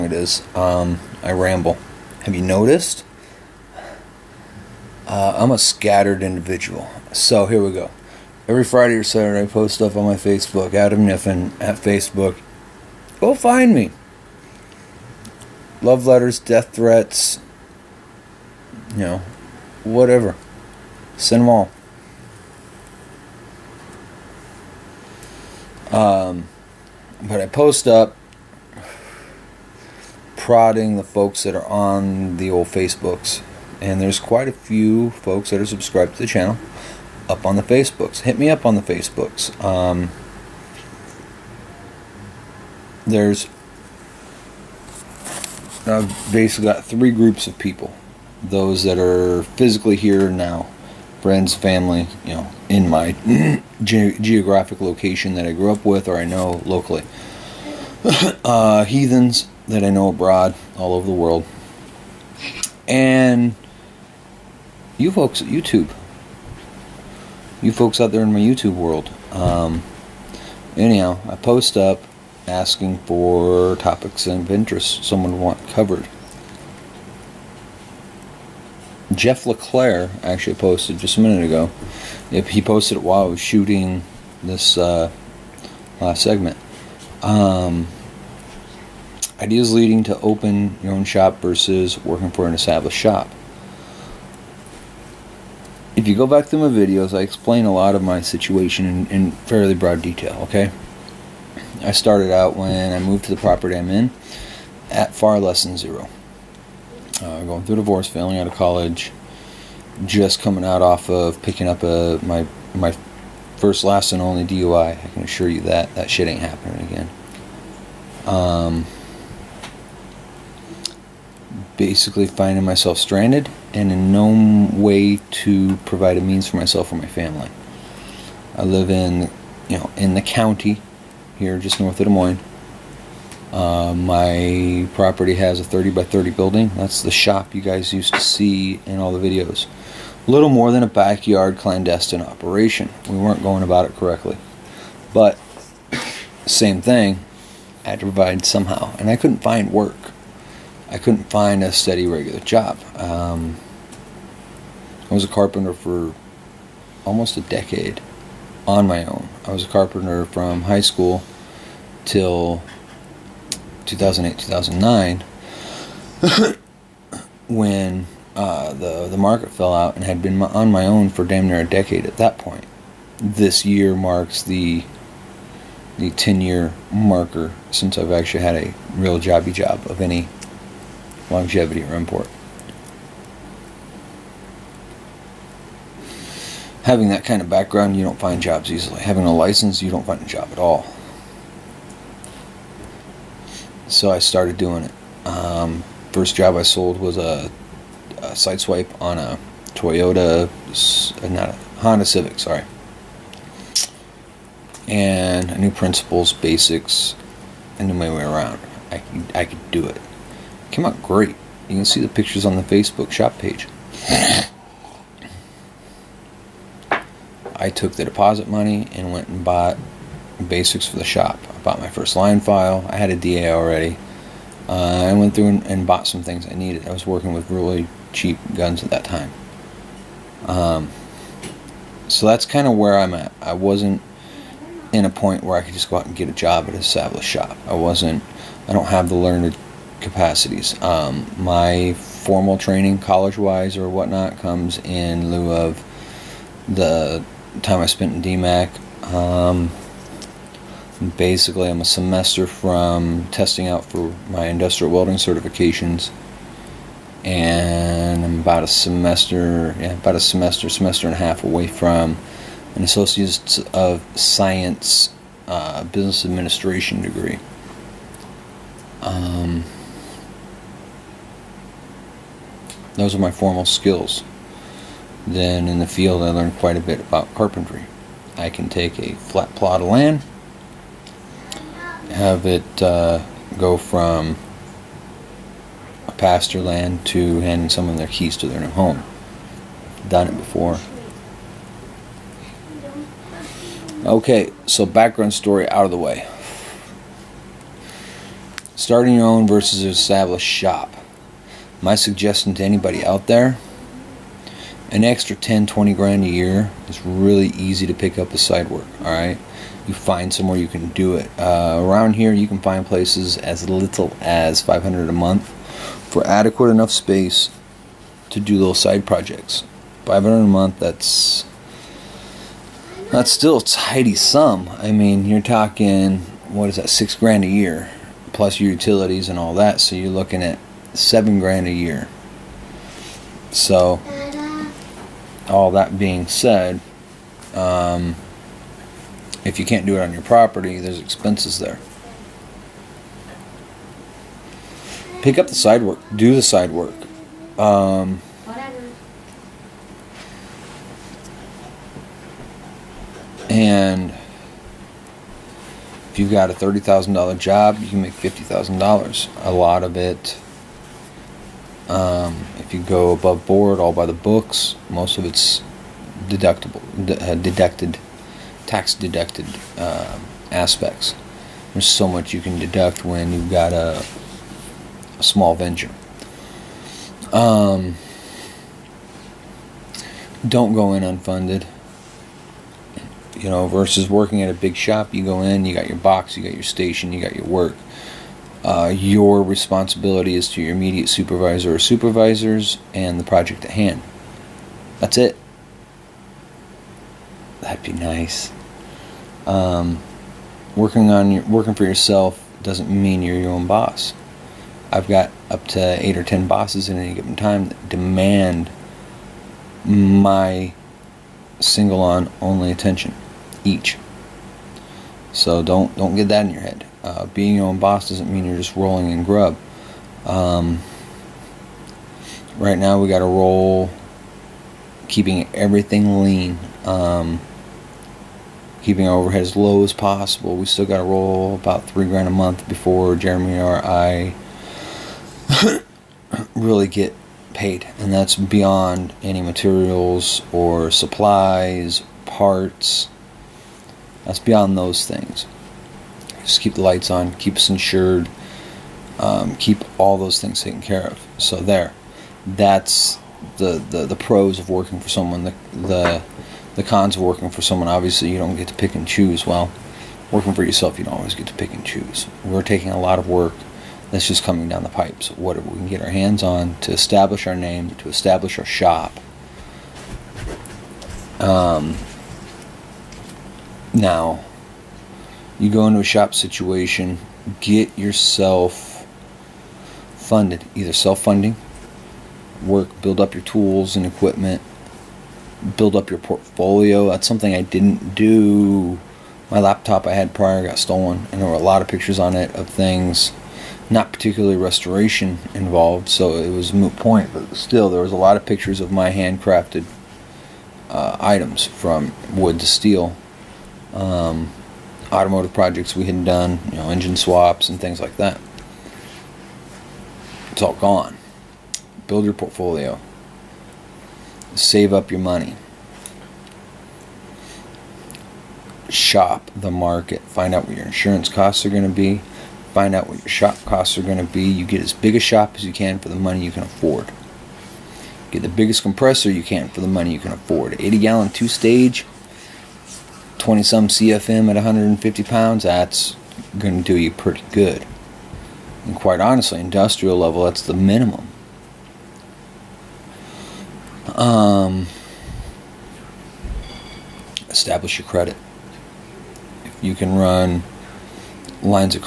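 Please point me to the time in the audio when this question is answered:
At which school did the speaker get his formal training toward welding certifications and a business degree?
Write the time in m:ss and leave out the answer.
4:08.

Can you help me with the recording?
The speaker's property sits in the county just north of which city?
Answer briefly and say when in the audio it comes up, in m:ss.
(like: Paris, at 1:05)
Des Moines, at 2:12.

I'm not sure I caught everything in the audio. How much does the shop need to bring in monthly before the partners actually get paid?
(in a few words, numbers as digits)
3 grand.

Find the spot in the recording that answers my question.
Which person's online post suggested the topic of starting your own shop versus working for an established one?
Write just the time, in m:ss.
1:19.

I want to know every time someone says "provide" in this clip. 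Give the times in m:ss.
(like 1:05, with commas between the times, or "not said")
2:05, 2:28.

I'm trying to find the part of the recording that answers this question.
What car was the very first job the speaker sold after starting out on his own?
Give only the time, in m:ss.
3:21.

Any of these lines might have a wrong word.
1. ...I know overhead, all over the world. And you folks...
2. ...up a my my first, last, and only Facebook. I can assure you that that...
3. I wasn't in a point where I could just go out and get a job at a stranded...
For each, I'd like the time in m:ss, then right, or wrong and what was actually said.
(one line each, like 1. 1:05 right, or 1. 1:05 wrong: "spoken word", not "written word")
1. 0:59 wrong: "abroad", not "overhead"
2. 1:51 wrong: "DUI", not "Facebook"
3. 3:53 wrong: "established", not "stranded".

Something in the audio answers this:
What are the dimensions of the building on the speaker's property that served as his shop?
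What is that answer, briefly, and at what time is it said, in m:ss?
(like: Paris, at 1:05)
30 by 30, at 2:15.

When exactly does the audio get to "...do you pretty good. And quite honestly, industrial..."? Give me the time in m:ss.
8:56.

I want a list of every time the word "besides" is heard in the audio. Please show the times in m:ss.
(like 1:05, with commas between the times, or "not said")
not said.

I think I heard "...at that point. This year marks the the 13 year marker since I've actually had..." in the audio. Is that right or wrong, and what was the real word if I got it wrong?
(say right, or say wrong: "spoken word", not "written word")
wrong: "10", not "13".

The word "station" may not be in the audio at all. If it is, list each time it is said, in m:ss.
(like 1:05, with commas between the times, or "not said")
6:26.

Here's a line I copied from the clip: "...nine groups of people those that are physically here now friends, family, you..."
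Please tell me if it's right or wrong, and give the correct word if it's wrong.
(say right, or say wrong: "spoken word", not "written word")
wrong: "three", not "nine".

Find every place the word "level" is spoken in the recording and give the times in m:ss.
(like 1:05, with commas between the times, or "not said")
9:00.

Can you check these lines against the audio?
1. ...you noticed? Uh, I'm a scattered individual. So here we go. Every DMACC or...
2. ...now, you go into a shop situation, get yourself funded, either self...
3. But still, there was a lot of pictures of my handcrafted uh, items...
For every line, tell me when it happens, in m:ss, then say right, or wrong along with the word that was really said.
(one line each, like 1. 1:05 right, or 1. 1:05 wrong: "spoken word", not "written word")
1. 0:02 wrong: "Friday", not "DMACC"
2. 7:53 right
3. 8:17 right.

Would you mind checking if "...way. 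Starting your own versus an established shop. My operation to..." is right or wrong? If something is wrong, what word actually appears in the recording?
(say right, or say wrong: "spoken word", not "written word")
wrong: "suggestion", not "operation".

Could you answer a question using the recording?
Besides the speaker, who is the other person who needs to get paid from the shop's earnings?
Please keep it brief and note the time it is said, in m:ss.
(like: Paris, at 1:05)
Jeremy, at 7:13.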